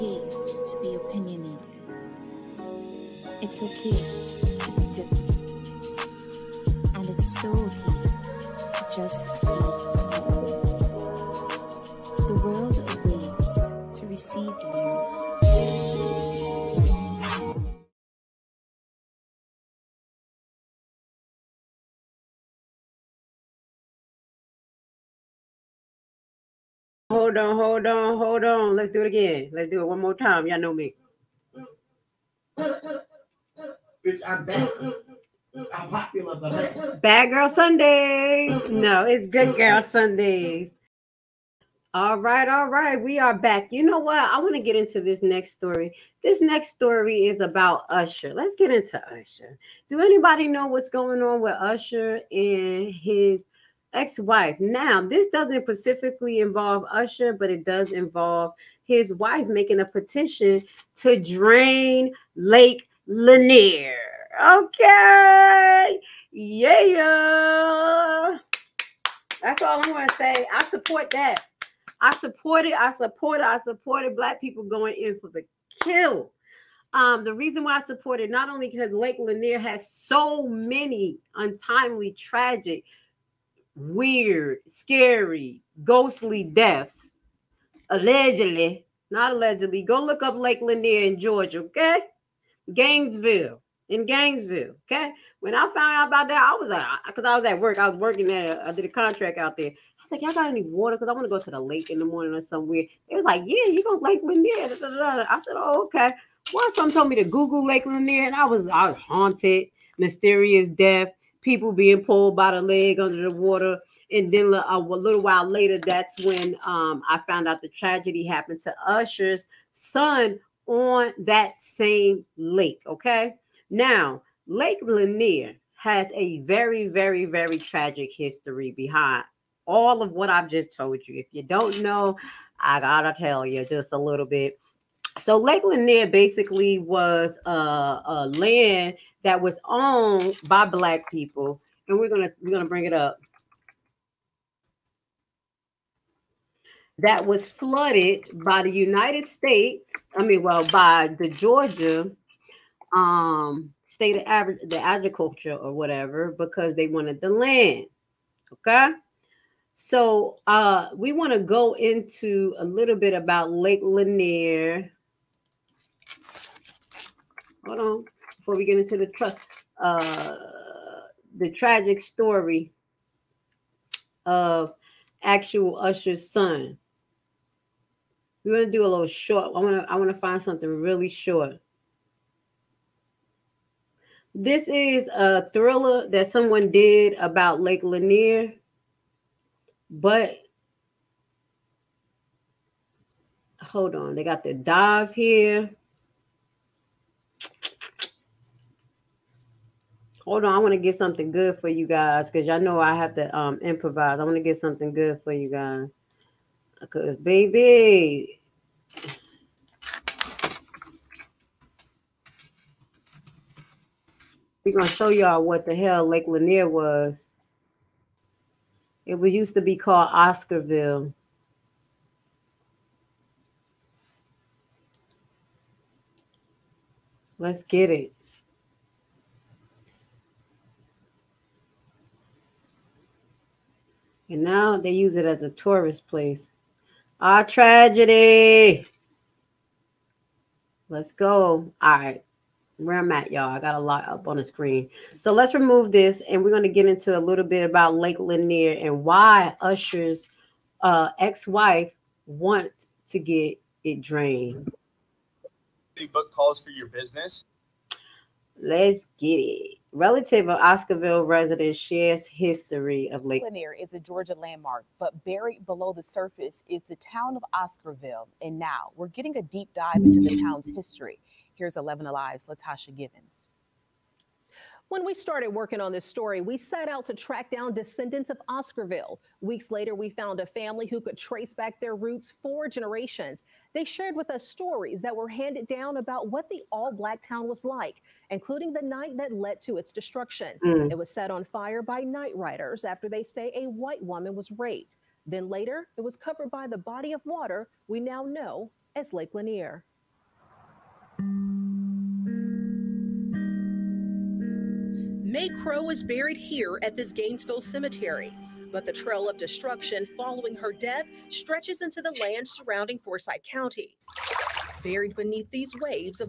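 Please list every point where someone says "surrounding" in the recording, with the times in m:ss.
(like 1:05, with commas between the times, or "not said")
5:12.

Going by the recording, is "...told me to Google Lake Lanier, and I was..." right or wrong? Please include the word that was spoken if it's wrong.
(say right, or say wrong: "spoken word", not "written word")
right.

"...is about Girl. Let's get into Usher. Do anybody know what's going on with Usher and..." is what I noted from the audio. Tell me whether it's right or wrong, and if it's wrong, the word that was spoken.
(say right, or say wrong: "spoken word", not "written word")
wrong: "Usher", not "Girl".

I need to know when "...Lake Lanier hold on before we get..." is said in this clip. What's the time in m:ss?
2:43.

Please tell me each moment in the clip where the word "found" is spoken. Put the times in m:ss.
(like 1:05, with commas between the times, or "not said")
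1:35, 1:57, 4:40.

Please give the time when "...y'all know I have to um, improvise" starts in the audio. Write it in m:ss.
3:22.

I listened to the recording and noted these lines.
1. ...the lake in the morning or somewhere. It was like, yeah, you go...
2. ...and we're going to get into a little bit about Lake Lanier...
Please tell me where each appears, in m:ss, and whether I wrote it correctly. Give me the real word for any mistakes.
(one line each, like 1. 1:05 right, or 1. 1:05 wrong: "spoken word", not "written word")
1. 1:41 right
2. 4:06 right.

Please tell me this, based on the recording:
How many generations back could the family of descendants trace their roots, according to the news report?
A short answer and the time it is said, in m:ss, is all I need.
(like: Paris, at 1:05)
4, at 4:42.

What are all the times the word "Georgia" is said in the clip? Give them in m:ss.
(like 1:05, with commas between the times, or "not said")
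1:31, 2:31, 4:24.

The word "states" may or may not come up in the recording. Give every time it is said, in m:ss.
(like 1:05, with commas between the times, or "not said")
2:29, 2:33.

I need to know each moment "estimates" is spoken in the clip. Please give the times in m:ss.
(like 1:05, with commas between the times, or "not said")
not said.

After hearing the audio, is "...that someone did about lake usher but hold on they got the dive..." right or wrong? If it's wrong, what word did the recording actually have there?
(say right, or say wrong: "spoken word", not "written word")
wrong: "lanier", not "usher".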